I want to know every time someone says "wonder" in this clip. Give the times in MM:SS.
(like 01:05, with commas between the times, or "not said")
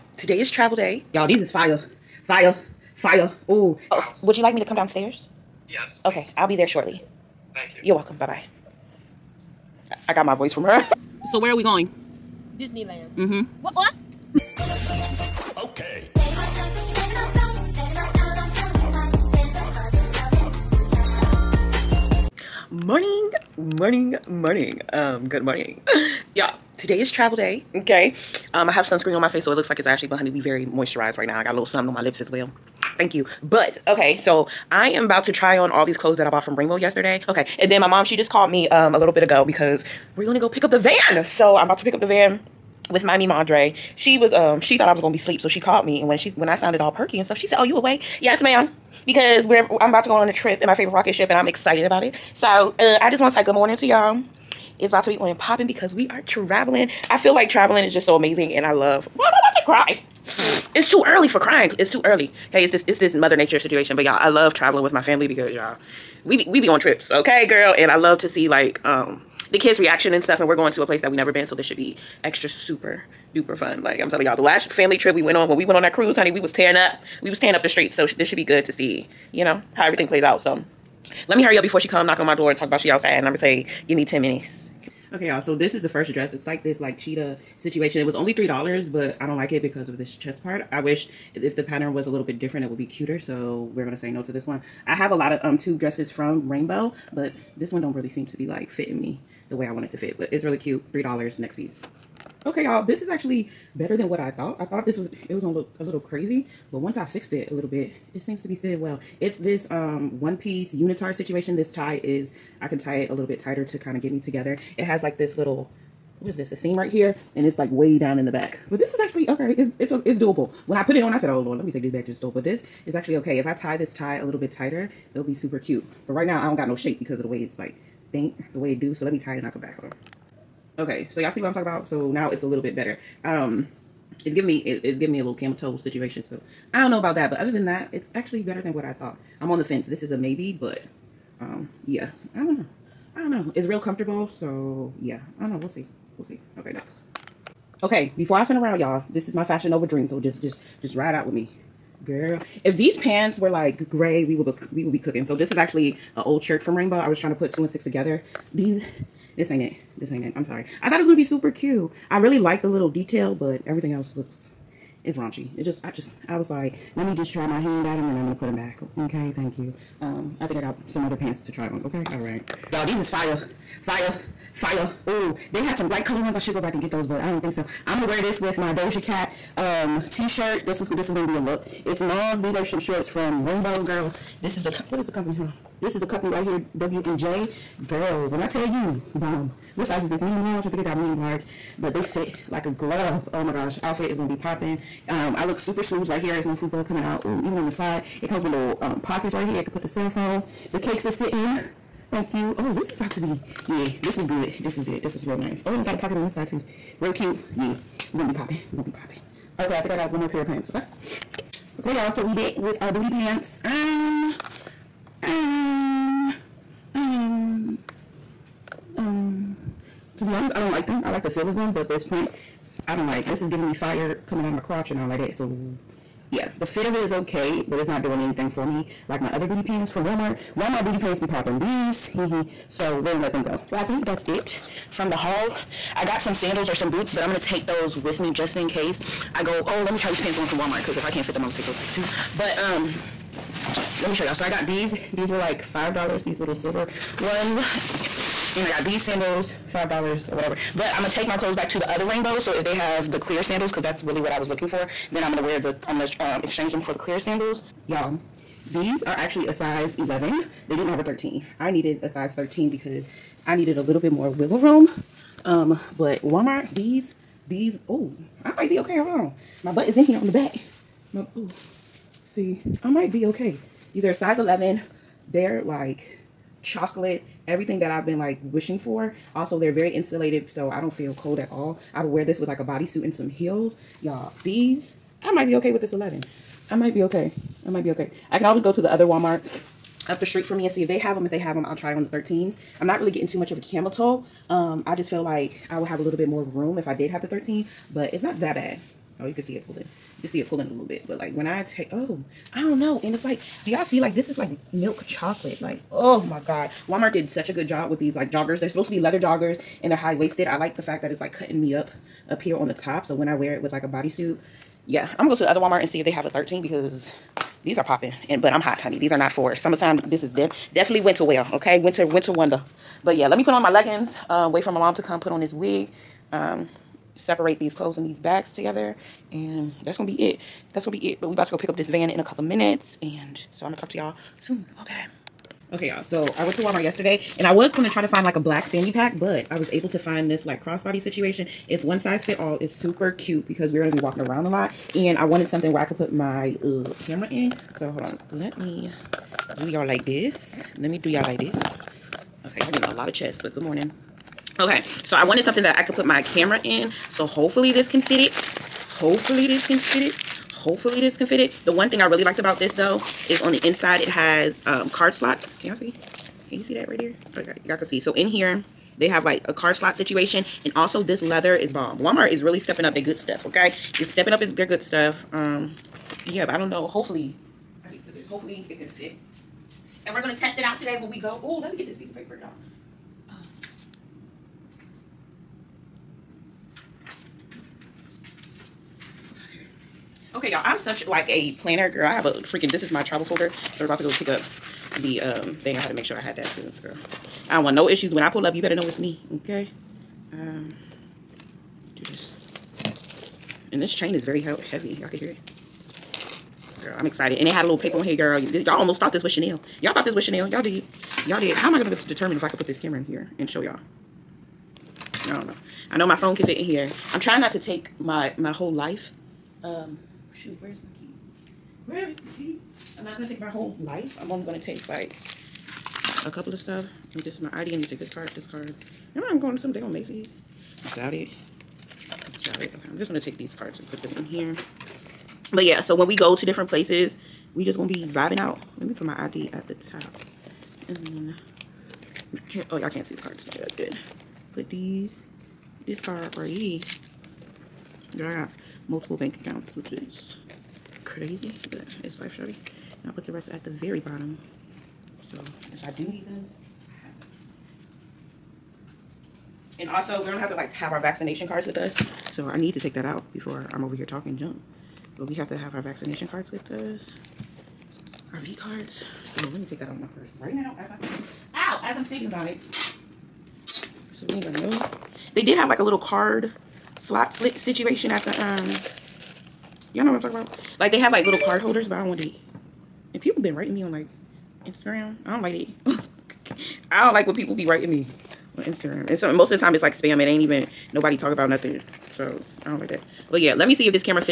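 05:22.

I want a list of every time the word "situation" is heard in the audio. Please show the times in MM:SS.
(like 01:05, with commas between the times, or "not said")
01:03, 01:27, 01:51, 02:15, 05:40, 06:09, 07:57.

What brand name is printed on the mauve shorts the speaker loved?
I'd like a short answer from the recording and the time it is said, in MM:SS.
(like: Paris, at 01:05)
W&J, at 03:06.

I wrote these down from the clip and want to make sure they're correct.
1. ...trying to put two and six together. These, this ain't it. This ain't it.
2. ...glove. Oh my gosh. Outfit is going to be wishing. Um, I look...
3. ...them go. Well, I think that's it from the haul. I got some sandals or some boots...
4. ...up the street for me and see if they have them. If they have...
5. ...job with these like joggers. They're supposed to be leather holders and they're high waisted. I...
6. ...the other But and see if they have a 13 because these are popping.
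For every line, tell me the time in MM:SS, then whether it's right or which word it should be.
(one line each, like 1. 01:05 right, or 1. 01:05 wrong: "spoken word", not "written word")
1. 02:37 right
2. 03:12 wrong: "popping", not "wishing"
3. 03:53 right
4. 04:50 right
5. 05:07 wrong: "joggers", not "holders"
6. 05:15 wrong: "Walmart", not "But".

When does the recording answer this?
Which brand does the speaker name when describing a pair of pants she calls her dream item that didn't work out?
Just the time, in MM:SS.
02:29.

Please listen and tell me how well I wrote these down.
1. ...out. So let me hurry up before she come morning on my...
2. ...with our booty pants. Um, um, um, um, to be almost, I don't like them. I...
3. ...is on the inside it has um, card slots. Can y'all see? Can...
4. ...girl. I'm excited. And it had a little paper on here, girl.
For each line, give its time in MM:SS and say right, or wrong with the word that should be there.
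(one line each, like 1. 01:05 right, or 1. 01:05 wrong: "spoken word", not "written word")
1. 01:20 wrong: "knocking", not "morning"
2. 03:32 wrong: "honest", not "almost"
3. 06:03 right
4. 06:46 right.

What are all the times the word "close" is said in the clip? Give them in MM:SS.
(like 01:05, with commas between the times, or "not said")
not said.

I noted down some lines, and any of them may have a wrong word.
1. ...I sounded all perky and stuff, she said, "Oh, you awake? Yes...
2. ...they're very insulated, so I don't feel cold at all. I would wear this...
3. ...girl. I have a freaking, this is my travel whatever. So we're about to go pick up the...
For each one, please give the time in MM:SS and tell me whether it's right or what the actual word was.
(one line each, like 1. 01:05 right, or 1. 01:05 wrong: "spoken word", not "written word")
1. 00:46 right
2. 04:39 right
3. 06:31 wrong: "folder", not "whatever".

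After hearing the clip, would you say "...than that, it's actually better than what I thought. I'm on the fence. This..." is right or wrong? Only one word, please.
right.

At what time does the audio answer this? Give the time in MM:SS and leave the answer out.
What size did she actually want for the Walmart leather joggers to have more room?
04:22.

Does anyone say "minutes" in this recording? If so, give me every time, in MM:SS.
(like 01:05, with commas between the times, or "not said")
01:24, 05:32.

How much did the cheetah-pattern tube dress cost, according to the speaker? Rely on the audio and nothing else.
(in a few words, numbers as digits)
$3.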